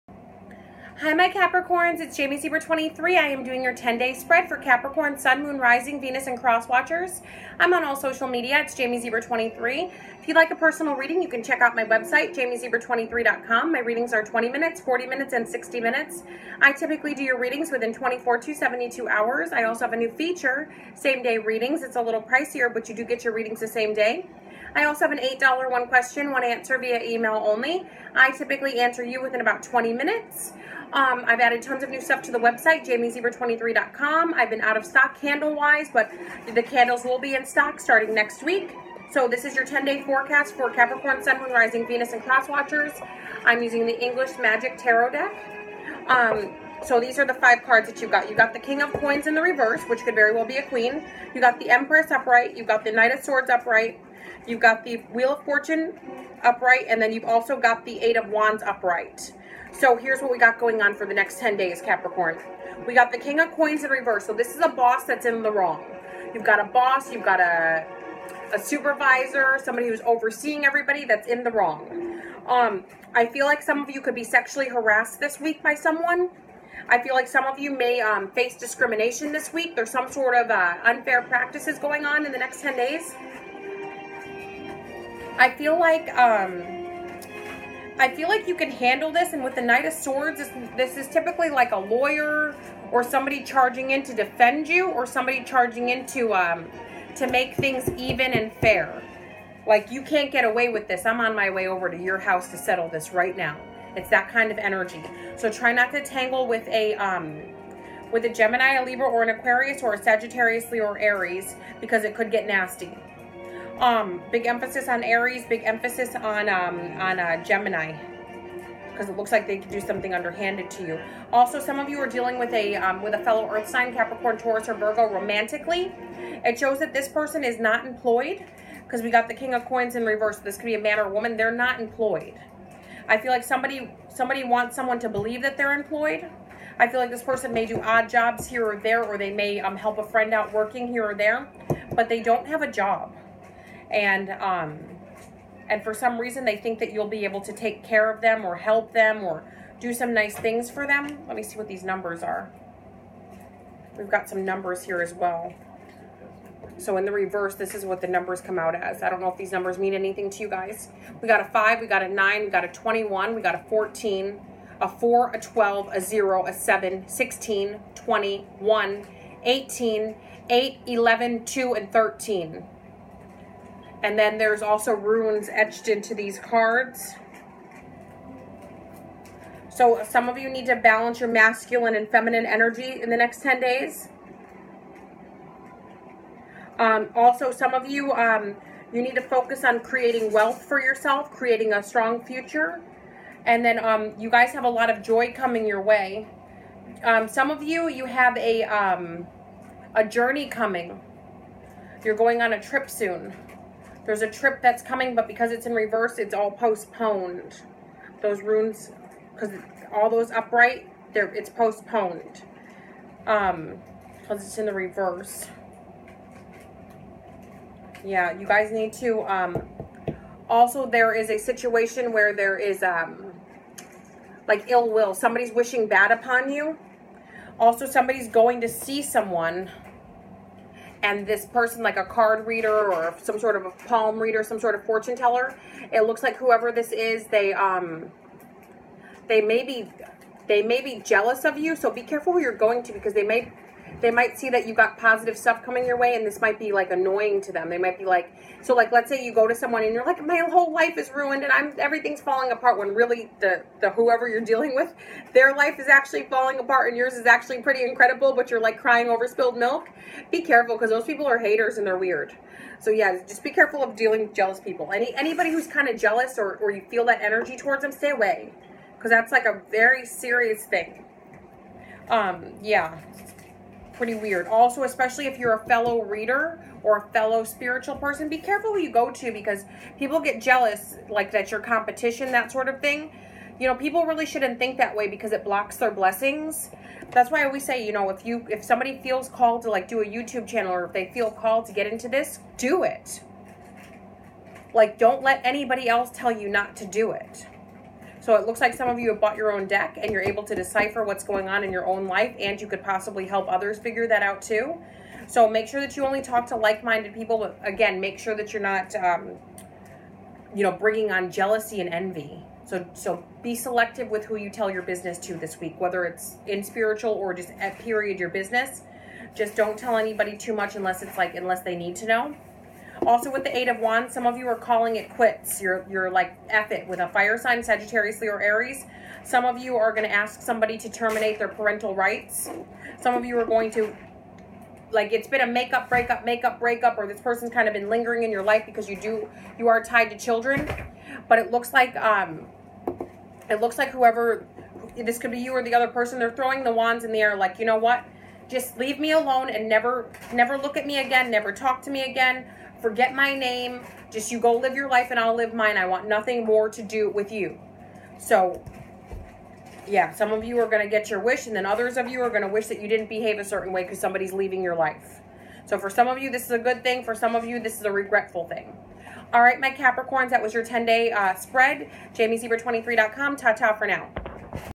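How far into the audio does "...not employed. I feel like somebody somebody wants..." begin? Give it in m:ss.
2:11.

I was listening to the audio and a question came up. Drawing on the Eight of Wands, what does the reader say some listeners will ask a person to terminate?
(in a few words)
Parental rights.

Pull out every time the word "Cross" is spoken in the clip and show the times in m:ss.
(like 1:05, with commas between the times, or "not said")
0:06, 0:42.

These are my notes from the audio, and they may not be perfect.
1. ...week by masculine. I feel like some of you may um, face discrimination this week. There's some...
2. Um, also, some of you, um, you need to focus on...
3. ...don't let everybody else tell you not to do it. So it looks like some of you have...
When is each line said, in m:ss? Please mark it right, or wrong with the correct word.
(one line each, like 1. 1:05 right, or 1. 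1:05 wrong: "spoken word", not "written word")
1. 1:15 wrong: "someone", not "masculine"
2. 3:06 right
3. 4:54 wrong: "anybody", not "everybody".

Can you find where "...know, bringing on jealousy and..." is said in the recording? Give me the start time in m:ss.
5:10.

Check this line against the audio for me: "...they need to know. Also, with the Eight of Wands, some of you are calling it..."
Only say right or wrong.
right.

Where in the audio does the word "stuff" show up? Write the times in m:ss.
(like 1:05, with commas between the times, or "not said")
0:32, 4:05.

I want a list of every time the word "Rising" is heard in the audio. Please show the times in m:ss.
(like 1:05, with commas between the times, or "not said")
0:05, 0:41.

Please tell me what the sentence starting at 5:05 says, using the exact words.
So make sure that you only talk to like-minded people.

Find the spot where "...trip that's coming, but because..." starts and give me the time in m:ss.
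3:24.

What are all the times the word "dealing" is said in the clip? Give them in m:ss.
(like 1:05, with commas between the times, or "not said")
2:02, 4:14, 4:23.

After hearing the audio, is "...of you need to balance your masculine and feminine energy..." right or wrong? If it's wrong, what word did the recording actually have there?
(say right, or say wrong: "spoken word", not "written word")
right.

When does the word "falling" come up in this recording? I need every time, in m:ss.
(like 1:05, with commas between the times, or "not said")
4:12, 4:16.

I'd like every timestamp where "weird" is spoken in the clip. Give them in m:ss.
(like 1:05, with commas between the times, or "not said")
4:21, 4:34.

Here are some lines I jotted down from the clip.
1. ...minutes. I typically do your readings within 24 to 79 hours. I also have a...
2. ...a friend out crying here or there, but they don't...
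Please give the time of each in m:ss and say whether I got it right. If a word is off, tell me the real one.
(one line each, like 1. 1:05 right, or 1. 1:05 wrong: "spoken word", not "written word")
1. 0:15 wrong: "72", not "79"
2. 2:19 wrong: "working", not "crying".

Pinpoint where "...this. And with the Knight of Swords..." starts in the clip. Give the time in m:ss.
1:29.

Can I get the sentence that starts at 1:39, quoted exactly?
Like you can't get away with this.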